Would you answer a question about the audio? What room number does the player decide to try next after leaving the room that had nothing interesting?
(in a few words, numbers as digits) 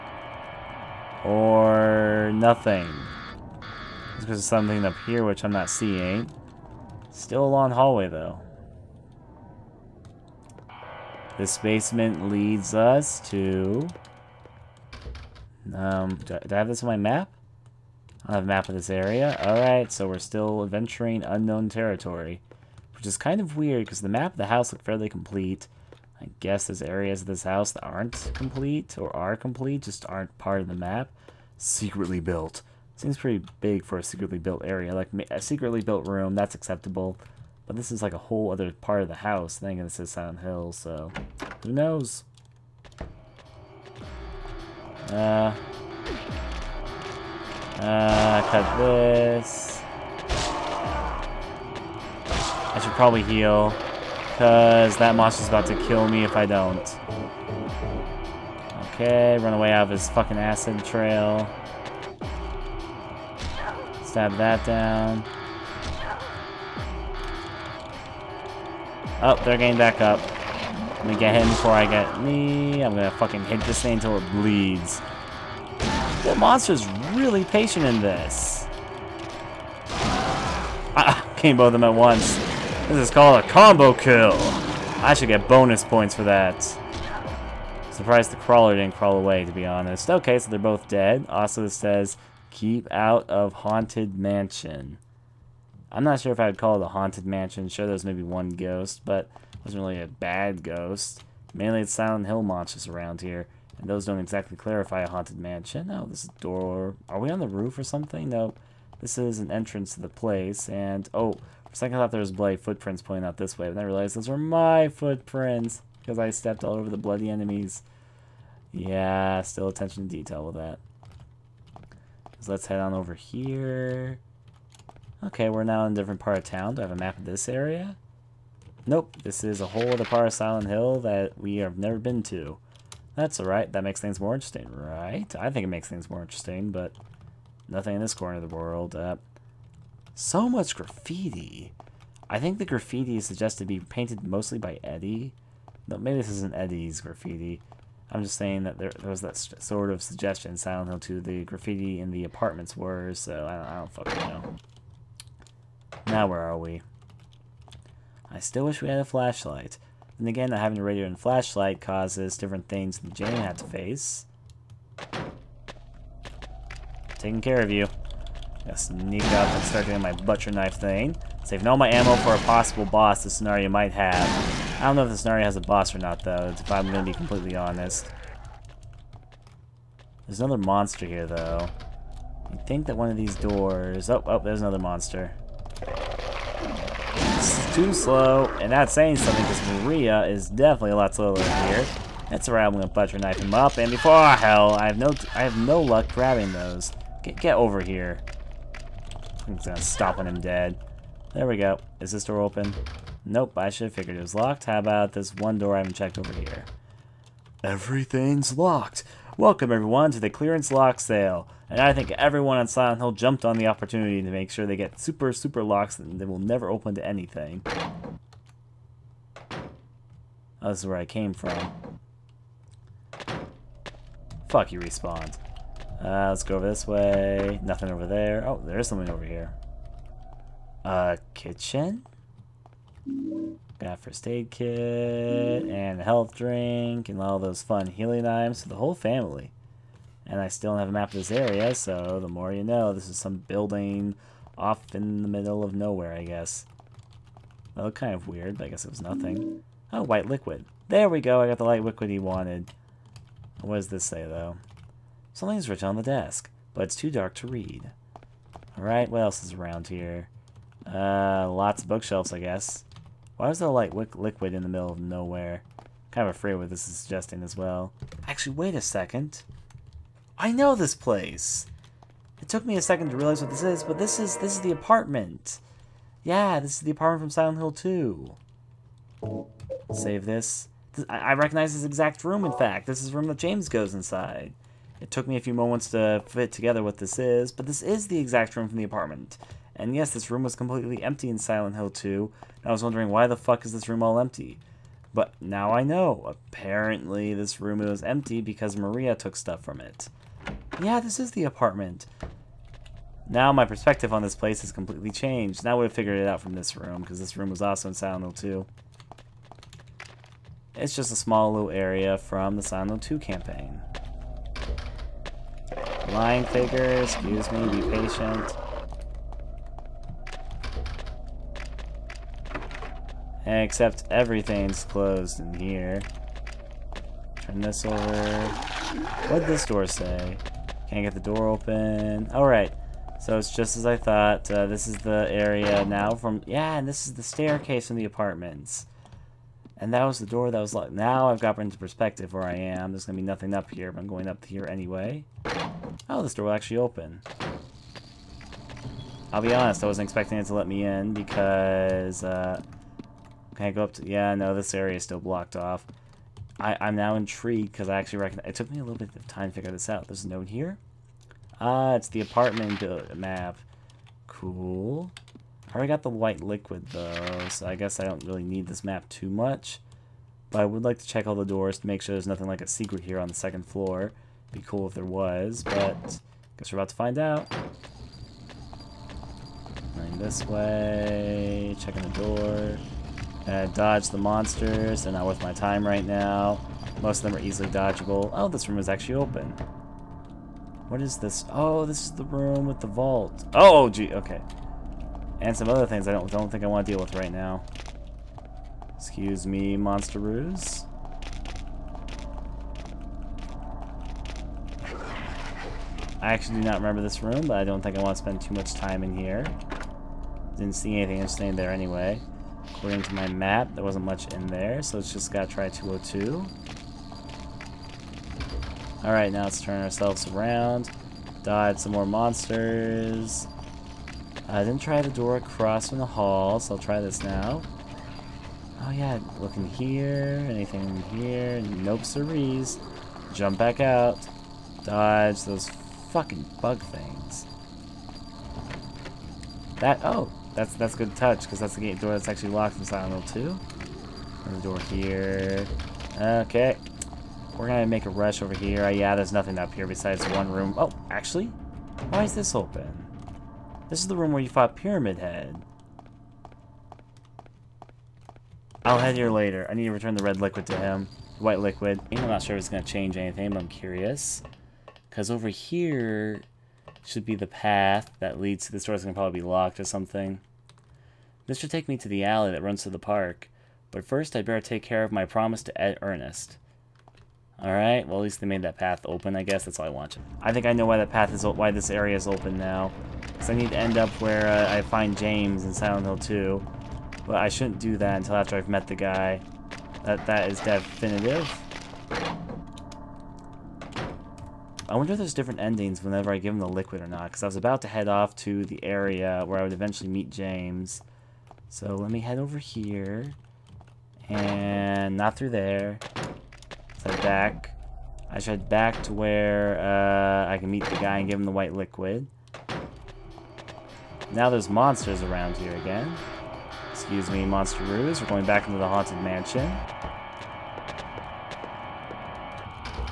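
202.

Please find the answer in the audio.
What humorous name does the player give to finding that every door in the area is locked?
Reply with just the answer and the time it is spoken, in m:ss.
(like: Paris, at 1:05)
clearance lock sale, at 3:30.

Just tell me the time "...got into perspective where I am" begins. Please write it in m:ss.
5:41.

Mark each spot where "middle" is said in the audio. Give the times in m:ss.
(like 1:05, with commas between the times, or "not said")
4:05, 4:24.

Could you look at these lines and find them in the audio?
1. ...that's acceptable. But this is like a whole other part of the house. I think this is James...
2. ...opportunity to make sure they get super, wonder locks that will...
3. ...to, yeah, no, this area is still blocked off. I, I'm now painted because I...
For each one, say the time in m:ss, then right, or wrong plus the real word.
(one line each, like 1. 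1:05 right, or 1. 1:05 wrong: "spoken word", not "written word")
1. 0:36 wrong: "Silent", not "James"
2. 3:33 wrong: "super", not "wonder"
3. 5:53 wrong: "intrigued", not "painted".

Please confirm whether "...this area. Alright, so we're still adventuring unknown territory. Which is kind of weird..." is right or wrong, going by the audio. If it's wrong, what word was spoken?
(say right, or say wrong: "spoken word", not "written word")
right.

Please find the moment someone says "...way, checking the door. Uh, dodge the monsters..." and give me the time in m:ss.
6:20.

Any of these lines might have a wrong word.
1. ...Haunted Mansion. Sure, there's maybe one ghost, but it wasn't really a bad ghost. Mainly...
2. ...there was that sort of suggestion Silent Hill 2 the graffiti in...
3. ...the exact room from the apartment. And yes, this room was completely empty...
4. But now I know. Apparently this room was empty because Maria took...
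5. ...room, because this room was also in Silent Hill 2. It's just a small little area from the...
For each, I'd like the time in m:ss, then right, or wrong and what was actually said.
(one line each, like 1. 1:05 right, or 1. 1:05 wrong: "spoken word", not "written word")
1. 1:36 right
2. 2:28 right
3. 4:48 right
4. 4:55 right
5. 5:06 right.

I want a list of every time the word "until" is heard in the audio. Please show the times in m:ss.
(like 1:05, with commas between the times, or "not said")
1:13, 8:08.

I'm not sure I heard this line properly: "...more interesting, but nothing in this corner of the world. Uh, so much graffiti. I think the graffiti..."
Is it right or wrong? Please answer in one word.
right.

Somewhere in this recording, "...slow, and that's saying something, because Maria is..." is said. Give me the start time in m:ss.
3:07.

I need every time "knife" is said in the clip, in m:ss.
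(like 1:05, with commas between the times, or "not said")
2:50, 3:13.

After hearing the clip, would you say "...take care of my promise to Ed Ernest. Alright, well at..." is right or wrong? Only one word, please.
right.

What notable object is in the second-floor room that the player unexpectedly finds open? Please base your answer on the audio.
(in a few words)
the vault.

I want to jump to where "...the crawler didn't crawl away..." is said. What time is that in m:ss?
1:28.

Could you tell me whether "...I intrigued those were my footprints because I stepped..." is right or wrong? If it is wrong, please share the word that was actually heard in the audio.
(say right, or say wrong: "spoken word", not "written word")
wrong: "realized", not "intrigued".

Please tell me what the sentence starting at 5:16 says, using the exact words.
Lying figure, excuse me, be patient.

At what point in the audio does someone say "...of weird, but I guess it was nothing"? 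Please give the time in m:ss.
4:08.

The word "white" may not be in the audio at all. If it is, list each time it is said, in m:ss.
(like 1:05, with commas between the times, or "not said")
4:10, 6:06, 7:41, 8:31.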